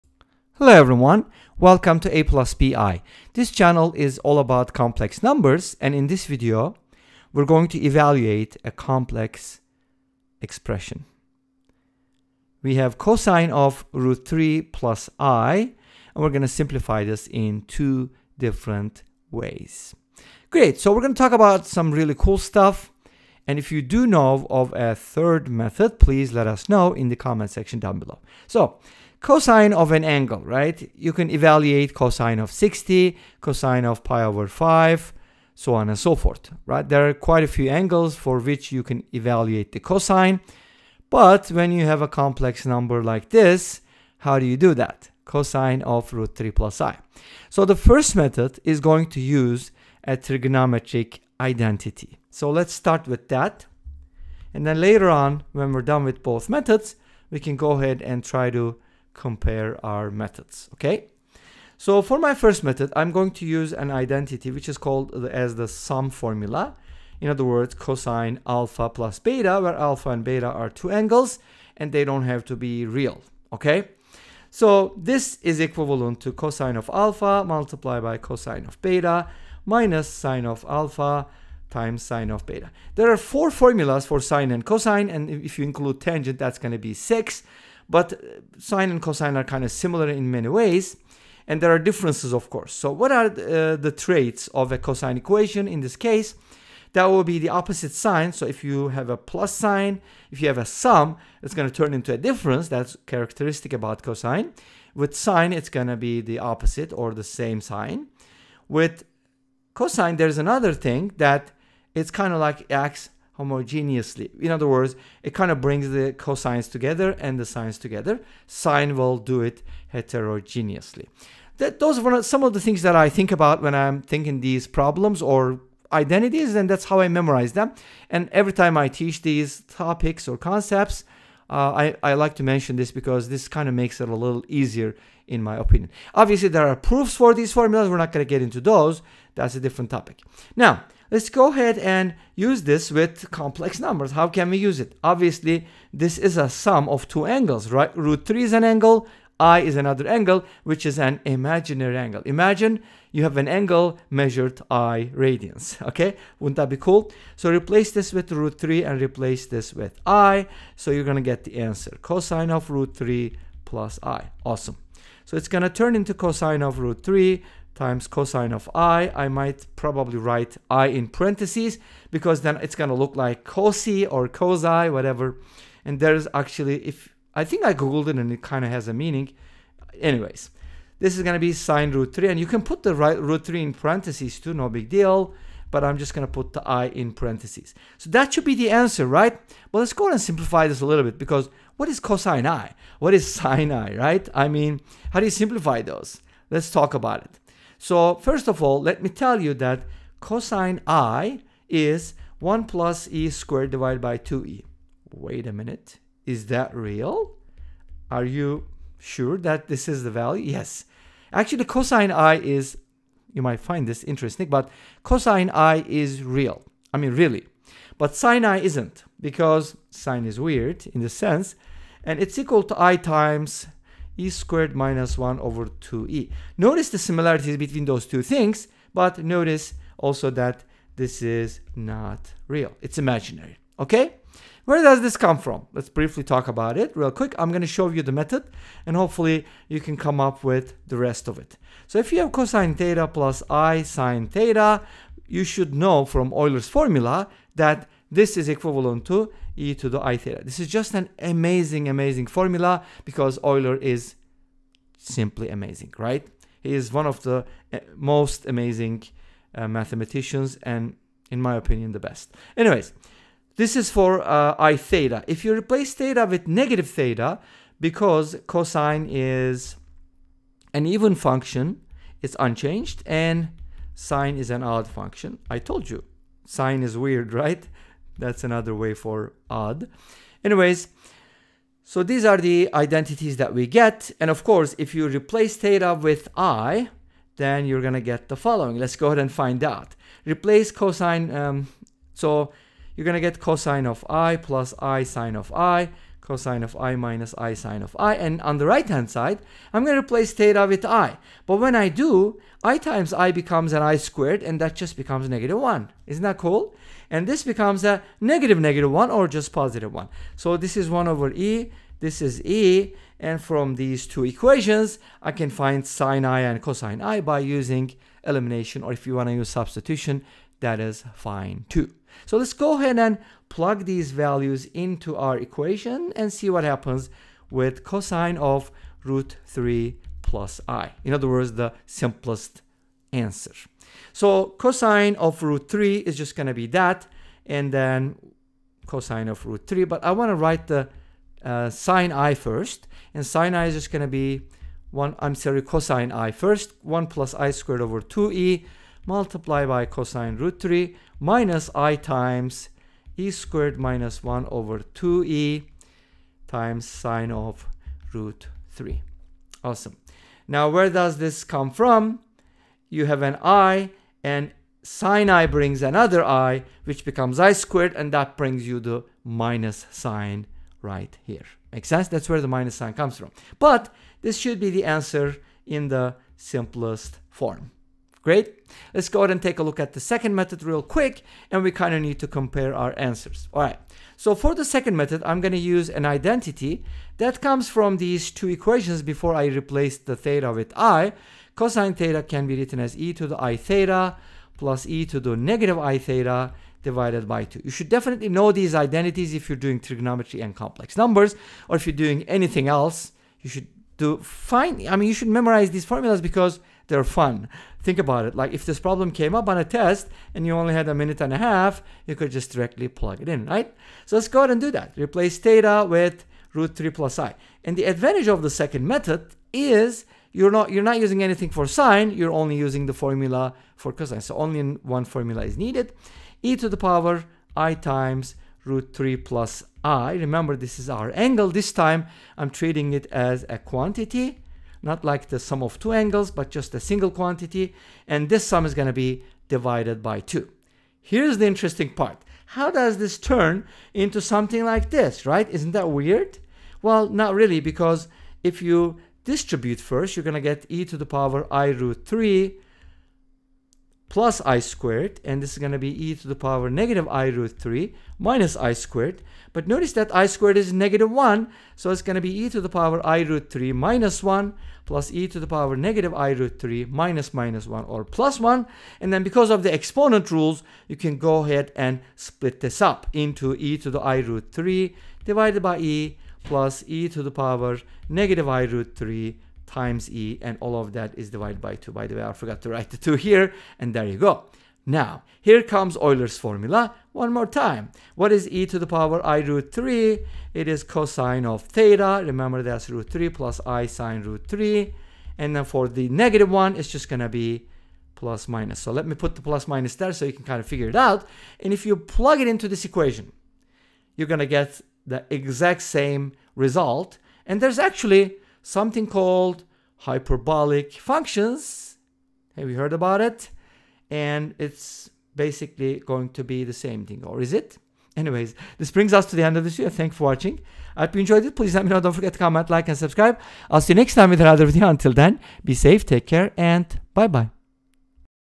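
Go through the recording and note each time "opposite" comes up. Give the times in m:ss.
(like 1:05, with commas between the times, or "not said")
1:37, 1:46.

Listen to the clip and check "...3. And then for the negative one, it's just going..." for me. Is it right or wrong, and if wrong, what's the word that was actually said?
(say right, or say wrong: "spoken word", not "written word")
right.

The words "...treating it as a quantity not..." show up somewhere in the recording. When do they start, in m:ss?
7:12.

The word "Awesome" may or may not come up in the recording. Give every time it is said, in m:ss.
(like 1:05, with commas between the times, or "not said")
2:44, 5:59.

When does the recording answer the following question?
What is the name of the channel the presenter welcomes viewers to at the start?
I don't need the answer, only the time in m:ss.
0:02.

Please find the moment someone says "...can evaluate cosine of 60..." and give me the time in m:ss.
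0:31.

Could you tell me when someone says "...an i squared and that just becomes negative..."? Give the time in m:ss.
5:03.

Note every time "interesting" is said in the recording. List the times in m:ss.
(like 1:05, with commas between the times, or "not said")
3:34, 7:21.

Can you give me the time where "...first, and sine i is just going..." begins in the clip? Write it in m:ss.
5:42.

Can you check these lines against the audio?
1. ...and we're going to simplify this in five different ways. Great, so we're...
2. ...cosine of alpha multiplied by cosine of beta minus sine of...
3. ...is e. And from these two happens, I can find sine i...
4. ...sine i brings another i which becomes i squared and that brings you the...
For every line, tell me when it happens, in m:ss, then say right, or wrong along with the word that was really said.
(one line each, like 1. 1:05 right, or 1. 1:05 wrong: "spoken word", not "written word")
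1. 0:16 wrong: "two", not "five"
2. 1:16 right
3. 5:12 wrong: "equations", not "happens"
4. 6:04 right.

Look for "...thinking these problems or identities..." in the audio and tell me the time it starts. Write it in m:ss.
2:04.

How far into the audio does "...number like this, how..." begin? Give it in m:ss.
0:42.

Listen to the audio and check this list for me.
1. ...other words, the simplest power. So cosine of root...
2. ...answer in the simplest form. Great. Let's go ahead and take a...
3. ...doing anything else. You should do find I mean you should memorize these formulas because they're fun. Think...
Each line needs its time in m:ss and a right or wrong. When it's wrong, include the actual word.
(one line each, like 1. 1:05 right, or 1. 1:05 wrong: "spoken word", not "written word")
1. 5:31 wrong: "answer", not "power"
2. 6:14 right
3. 6:41 right.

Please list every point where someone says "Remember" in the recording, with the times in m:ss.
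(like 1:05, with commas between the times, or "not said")
7:10, 8:12.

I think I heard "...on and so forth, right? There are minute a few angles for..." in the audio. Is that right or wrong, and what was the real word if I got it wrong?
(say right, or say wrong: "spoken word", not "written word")
wrong: "quite", not "minute".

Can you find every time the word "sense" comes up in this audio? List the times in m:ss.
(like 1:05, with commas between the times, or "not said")
3:41, 6:11.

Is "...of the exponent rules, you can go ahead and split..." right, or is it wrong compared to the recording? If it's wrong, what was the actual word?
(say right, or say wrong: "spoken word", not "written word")
right.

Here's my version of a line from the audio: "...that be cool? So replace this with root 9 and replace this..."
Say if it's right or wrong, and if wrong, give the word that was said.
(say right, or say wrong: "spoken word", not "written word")
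wrong: "3", not "9".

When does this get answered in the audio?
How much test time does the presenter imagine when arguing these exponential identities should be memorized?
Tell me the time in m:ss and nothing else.
6:50.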